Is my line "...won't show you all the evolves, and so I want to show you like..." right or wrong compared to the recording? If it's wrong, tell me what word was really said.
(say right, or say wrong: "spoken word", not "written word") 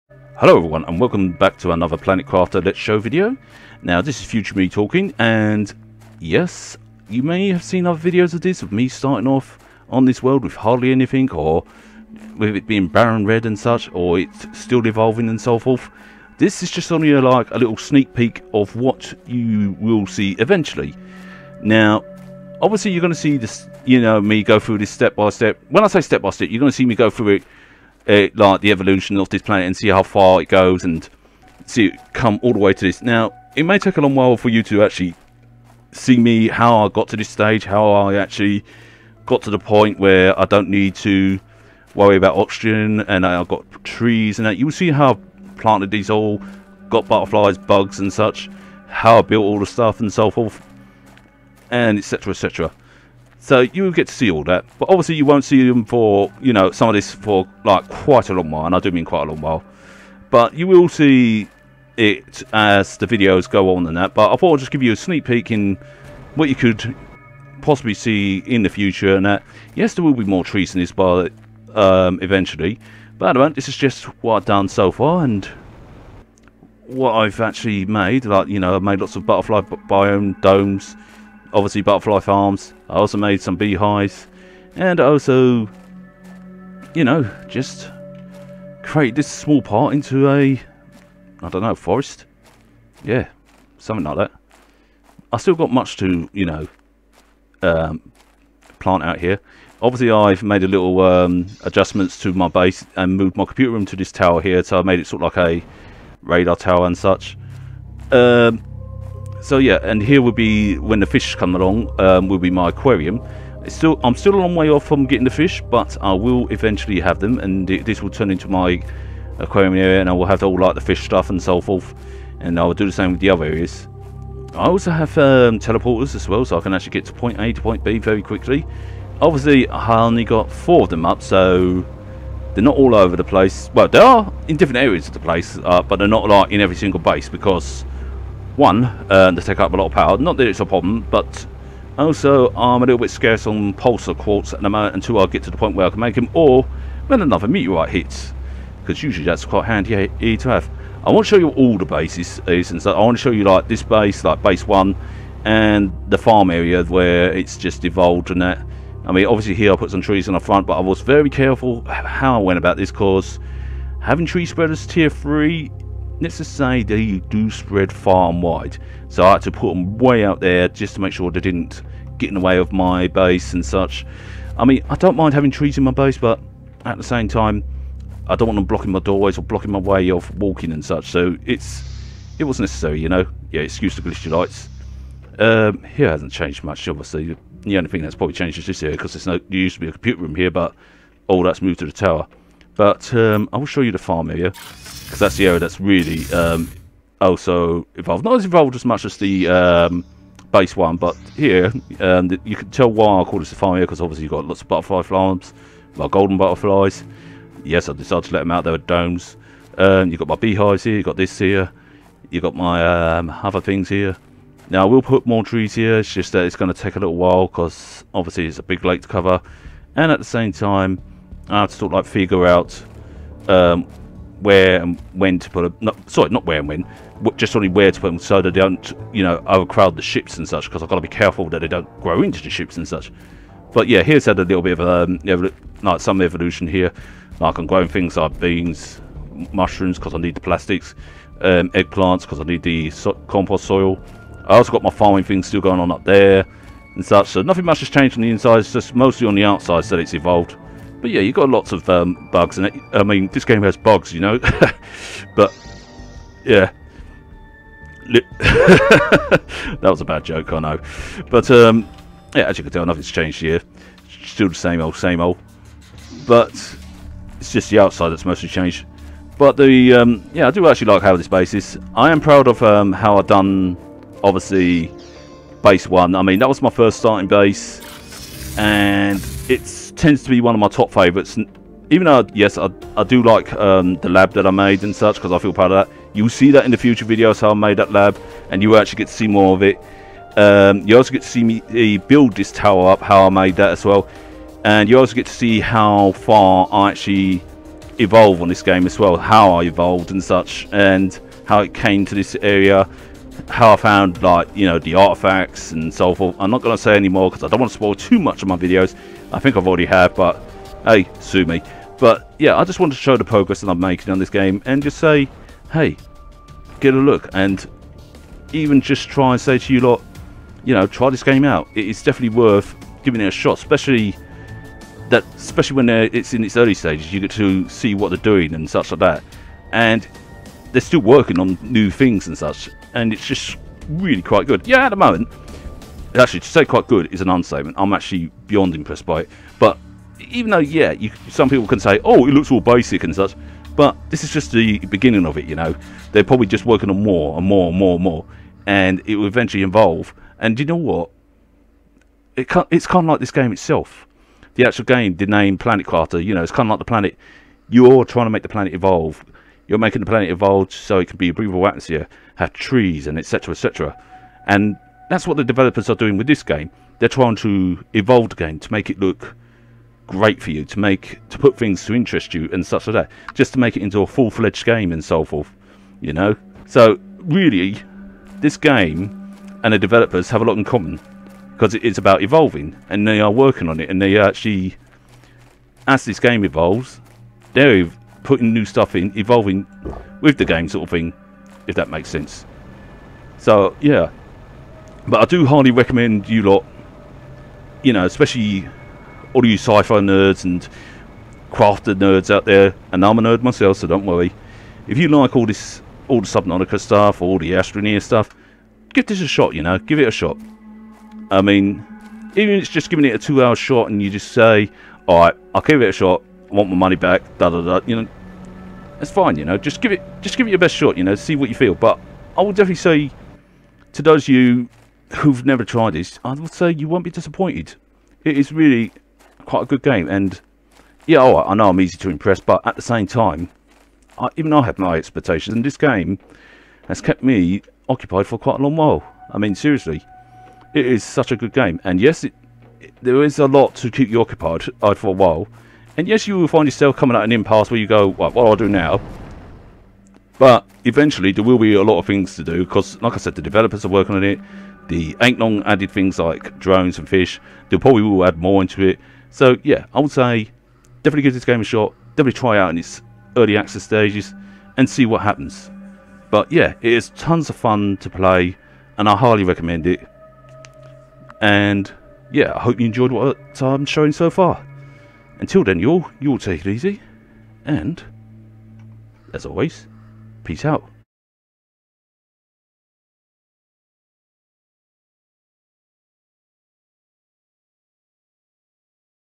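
wrong: "bases", not "evolves".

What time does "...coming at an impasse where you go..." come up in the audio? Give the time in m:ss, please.
7:26.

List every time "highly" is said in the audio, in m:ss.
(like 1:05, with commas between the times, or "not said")
6:35, 7:49.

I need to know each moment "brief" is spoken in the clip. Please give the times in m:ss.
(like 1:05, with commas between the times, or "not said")
not said.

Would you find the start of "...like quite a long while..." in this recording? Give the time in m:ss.
0:57.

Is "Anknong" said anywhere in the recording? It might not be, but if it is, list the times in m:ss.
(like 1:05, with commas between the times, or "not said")
7:35.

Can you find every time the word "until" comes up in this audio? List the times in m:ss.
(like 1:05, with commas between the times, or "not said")
2:24, 7:55.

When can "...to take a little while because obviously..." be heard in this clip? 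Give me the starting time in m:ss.
3:36.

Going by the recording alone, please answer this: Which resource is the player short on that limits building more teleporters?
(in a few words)
pulsar quartz.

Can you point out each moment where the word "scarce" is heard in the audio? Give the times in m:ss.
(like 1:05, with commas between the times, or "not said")
2:23.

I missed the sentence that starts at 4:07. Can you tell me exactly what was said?
So nothing much has changed on the inside.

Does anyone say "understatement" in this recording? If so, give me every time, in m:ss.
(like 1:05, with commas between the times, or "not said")
5:37.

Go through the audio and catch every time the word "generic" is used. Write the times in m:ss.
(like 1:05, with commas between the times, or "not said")
not said.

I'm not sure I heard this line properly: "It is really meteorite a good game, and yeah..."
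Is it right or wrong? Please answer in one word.
wrong.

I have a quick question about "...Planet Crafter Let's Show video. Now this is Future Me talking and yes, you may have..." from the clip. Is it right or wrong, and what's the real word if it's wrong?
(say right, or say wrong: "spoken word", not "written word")
right.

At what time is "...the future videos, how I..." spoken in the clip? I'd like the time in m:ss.
4:46.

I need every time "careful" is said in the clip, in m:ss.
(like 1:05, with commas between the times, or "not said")
2:41, 3:51.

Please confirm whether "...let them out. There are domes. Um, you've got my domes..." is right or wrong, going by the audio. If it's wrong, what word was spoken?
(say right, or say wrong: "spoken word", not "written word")
wrong: "beehives", not "domes".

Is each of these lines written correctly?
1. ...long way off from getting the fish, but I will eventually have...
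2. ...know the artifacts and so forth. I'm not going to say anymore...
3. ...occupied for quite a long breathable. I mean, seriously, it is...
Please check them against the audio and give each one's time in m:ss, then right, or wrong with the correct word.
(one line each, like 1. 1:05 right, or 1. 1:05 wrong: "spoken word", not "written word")
1. 1:54 right
2. 5:04 right
3. 7:17 wrong: "while", not "breathable".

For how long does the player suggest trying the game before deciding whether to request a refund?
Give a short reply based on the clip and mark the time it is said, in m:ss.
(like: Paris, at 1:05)
2 hours, at 6:53.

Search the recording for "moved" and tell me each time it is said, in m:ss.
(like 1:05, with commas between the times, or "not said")
1:43, 3:11.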